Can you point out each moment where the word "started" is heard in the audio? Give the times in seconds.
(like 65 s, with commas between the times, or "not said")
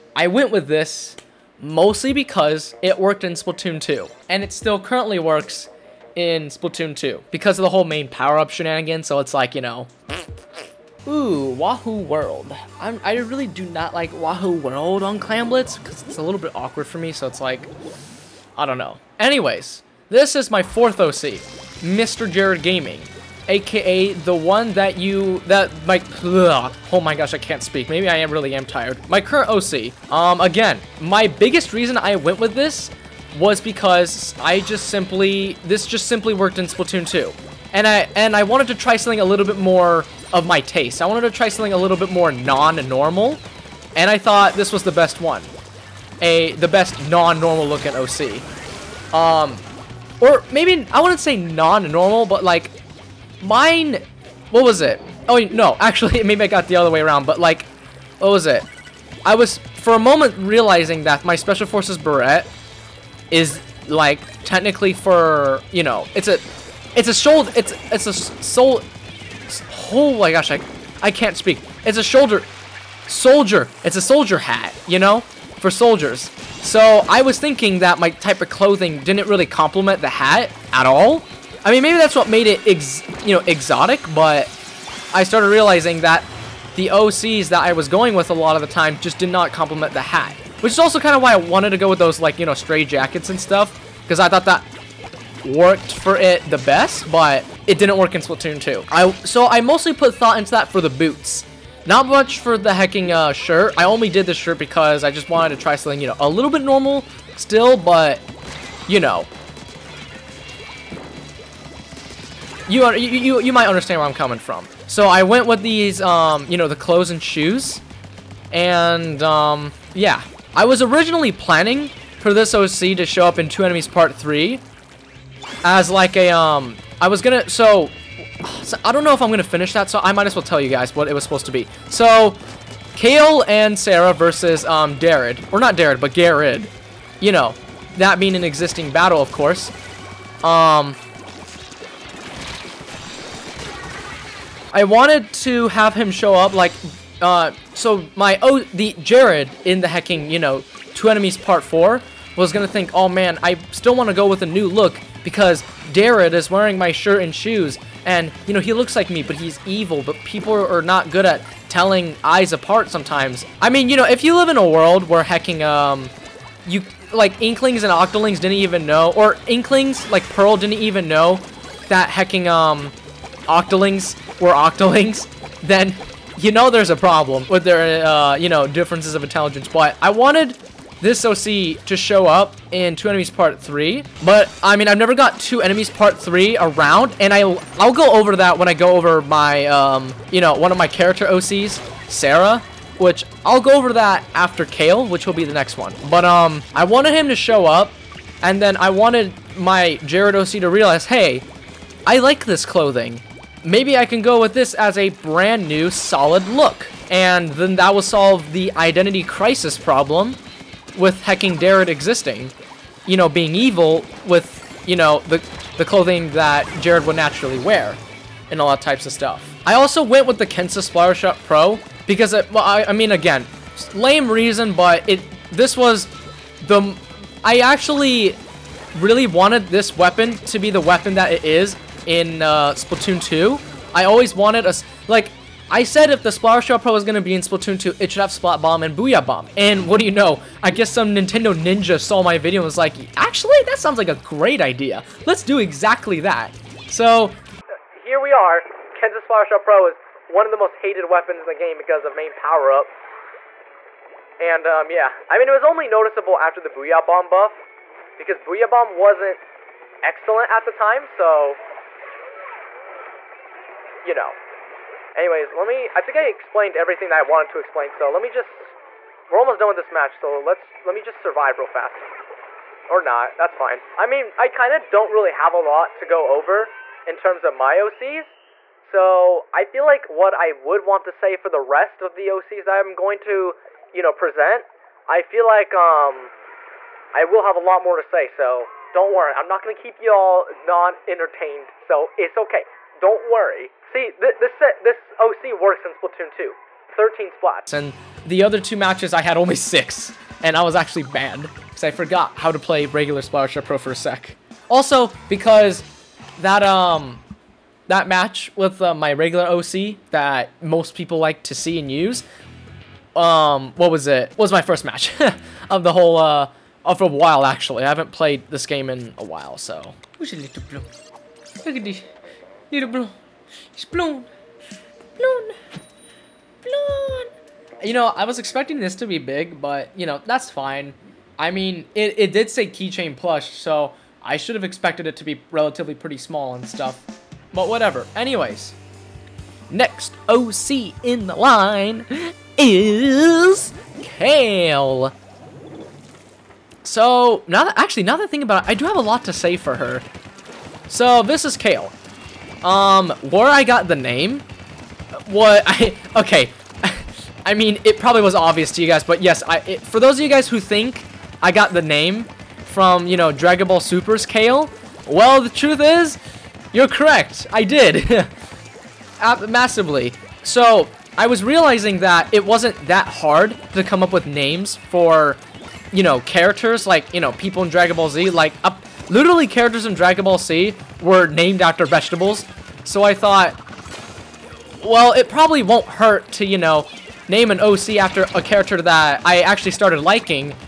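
85 s, 389 s.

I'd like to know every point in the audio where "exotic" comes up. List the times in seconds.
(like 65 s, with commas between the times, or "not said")
83 s.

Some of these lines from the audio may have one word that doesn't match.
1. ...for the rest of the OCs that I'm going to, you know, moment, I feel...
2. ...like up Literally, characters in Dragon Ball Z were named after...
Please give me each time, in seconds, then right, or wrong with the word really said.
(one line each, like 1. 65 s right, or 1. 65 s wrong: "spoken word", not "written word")
1. 281 s wrong: "present", not "moment"
2. 378 s right.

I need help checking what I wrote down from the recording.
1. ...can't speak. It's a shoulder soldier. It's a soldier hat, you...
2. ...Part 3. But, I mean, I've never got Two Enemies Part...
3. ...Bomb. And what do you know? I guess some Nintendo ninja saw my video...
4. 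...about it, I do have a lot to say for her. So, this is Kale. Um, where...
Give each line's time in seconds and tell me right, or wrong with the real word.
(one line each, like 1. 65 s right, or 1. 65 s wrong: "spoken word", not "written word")
1. 71 s right
2. 183 s right
3. 239 s right
4. 348 s right.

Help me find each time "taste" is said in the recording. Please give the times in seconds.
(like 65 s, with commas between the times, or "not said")
40 s.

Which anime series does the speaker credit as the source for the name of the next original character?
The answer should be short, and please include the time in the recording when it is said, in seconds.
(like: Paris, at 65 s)
Dragon Ball Super, at 363 s.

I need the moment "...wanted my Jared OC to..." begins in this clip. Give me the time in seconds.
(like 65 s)
198 s.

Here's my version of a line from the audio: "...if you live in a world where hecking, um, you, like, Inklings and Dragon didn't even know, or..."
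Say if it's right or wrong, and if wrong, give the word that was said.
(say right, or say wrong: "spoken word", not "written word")
wrong: "Octolings", not "Dragon".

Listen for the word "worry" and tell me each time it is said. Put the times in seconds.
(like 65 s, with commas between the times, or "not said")
289 s, 293 s.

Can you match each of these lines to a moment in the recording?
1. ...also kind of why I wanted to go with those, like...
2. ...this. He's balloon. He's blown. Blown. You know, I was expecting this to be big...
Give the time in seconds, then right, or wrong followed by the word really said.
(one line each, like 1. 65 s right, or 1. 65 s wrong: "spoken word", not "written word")
1. 90 s right
2. 321 s right.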